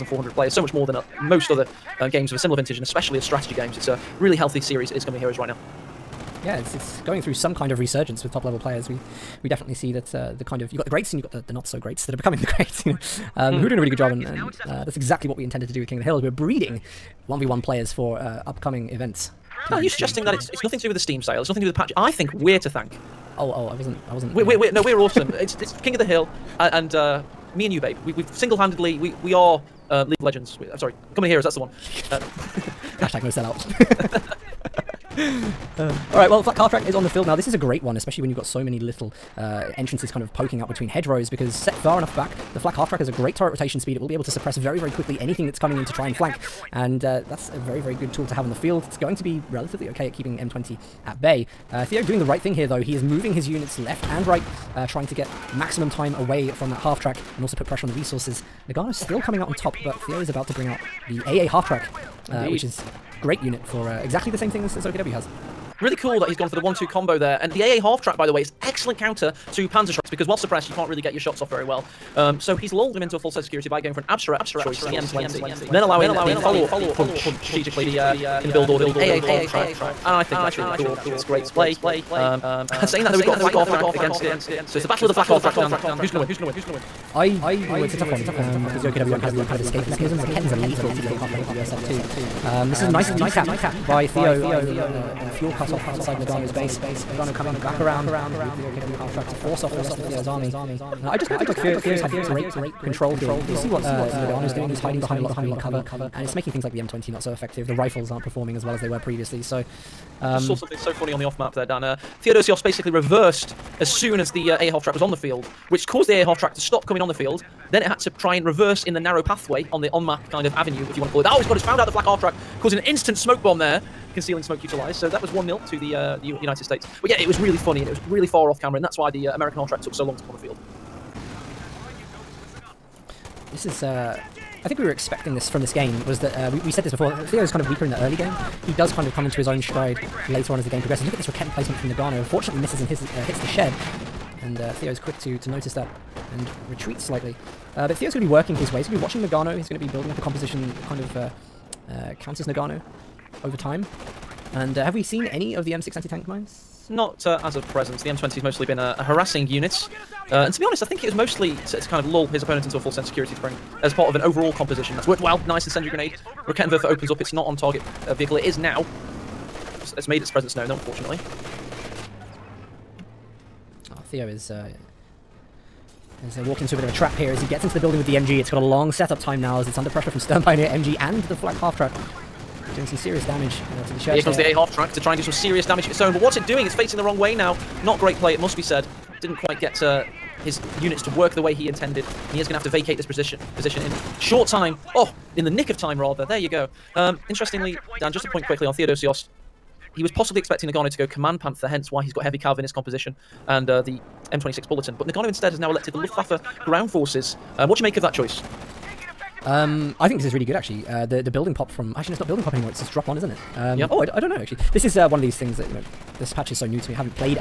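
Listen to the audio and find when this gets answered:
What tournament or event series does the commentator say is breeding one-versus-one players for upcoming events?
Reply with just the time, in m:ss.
0:15.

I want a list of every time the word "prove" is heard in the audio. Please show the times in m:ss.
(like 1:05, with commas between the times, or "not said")
not said.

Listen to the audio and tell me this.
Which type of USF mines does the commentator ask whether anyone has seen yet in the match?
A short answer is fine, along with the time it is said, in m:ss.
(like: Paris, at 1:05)
M6 anti-tank mines, at 2:35.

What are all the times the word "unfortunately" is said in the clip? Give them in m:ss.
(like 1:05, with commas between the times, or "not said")
2:50.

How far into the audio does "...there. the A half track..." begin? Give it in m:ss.
3:04.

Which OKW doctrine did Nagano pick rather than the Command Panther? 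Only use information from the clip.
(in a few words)
Luftwaffe ground forces.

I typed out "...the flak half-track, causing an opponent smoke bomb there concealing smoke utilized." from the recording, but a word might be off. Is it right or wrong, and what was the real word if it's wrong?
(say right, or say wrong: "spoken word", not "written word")
wrong: "instant", not "opponent".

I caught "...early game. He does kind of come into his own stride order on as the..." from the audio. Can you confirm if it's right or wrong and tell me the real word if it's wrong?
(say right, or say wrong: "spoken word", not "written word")
wrong: "later", not "order".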